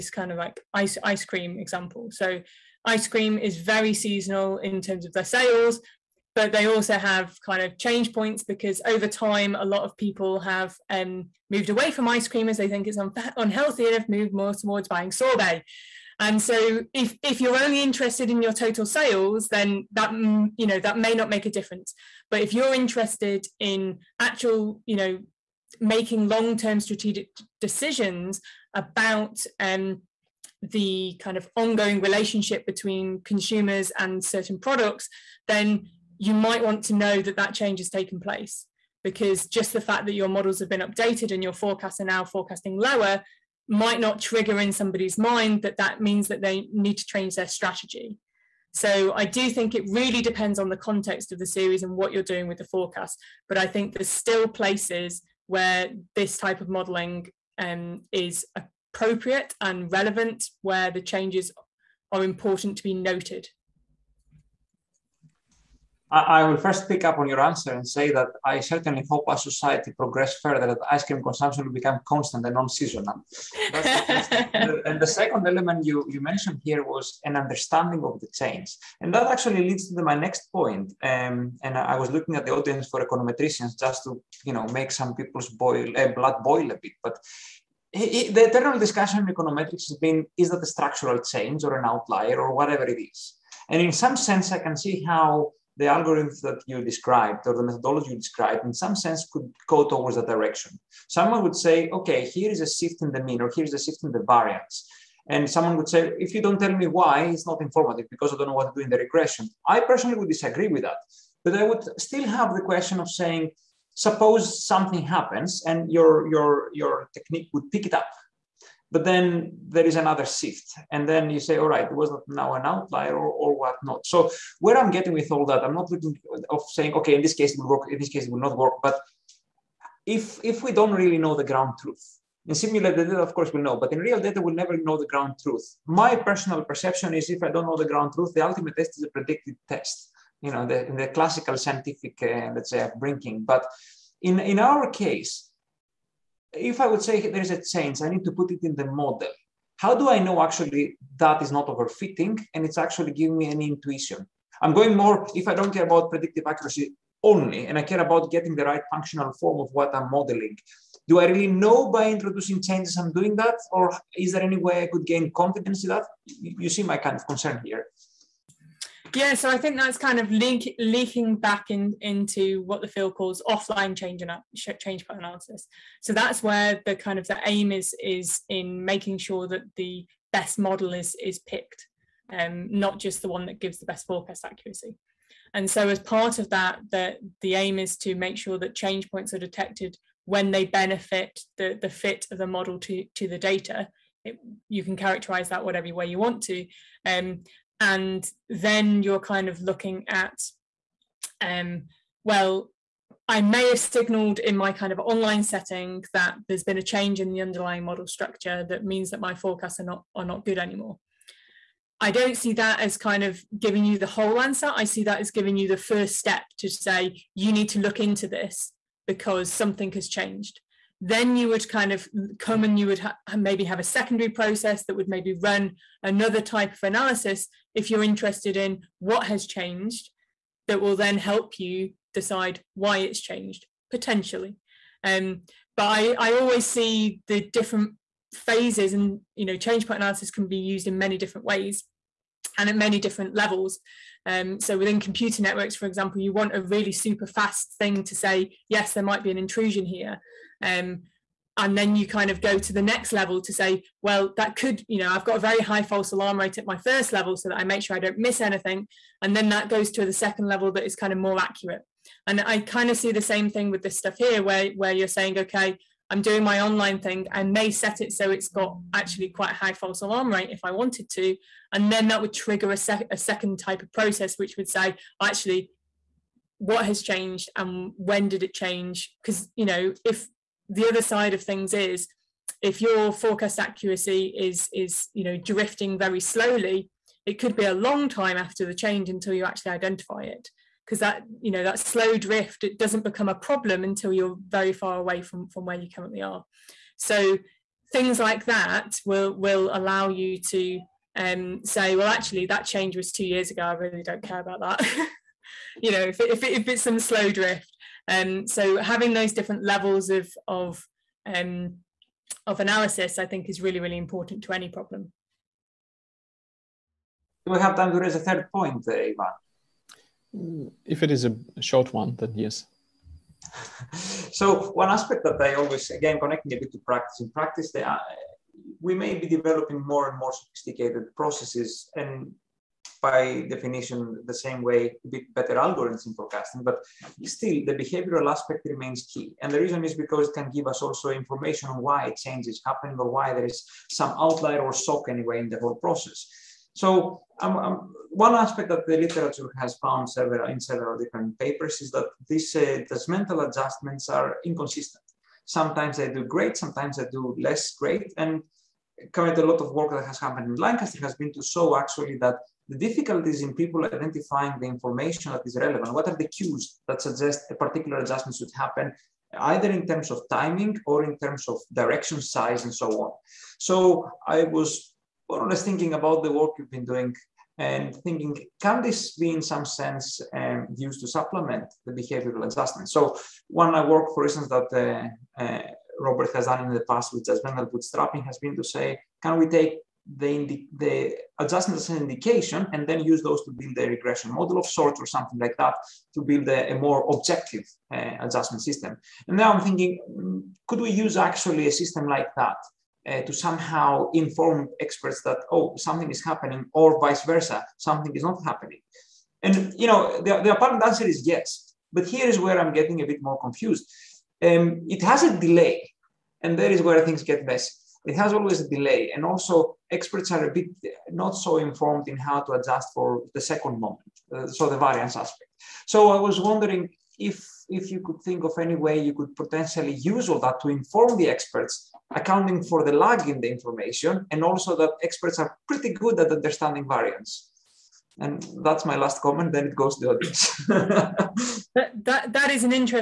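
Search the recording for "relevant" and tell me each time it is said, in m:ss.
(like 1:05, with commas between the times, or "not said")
0:59, 6:05.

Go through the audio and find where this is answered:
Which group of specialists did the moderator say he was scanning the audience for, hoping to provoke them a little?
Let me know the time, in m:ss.
1:23.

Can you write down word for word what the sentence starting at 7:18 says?
And that's my last comment, then it goes to the audience.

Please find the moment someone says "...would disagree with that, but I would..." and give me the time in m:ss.
1:50.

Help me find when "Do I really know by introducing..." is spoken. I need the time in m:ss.
2:41.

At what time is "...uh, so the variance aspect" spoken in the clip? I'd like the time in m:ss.
7:04.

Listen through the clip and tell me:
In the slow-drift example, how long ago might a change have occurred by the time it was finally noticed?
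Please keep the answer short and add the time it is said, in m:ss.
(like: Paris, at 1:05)
2 years, at 5:03.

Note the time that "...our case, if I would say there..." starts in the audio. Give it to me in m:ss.
2:24.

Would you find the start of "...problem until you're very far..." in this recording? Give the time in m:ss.
4:53.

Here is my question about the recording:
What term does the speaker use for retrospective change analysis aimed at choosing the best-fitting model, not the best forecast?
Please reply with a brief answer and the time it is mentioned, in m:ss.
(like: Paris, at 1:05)
Offline change, at 2:53.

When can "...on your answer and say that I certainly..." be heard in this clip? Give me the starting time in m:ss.
1:07.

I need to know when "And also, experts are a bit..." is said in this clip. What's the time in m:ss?
6:59.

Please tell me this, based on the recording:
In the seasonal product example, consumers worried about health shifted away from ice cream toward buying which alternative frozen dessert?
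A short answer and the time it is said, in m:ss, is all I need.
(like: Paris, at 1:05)
Sorbet, at 0:15.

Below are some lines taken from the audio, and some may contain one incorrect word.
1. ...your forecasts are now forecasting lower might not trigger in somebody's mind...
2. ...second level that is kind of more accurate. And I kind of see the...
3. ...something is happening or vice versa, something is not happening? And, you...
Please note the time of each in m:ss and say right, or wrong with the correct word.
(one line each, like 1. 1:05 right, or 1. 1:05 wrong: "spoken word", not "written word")
1. 0:41 right
2. 4:20 right
3. 6:45 right.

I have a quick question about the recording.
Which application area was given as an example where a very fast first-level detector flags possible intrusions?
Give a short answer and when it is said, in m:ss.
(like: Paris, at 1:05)
Computer networks, at 4:05.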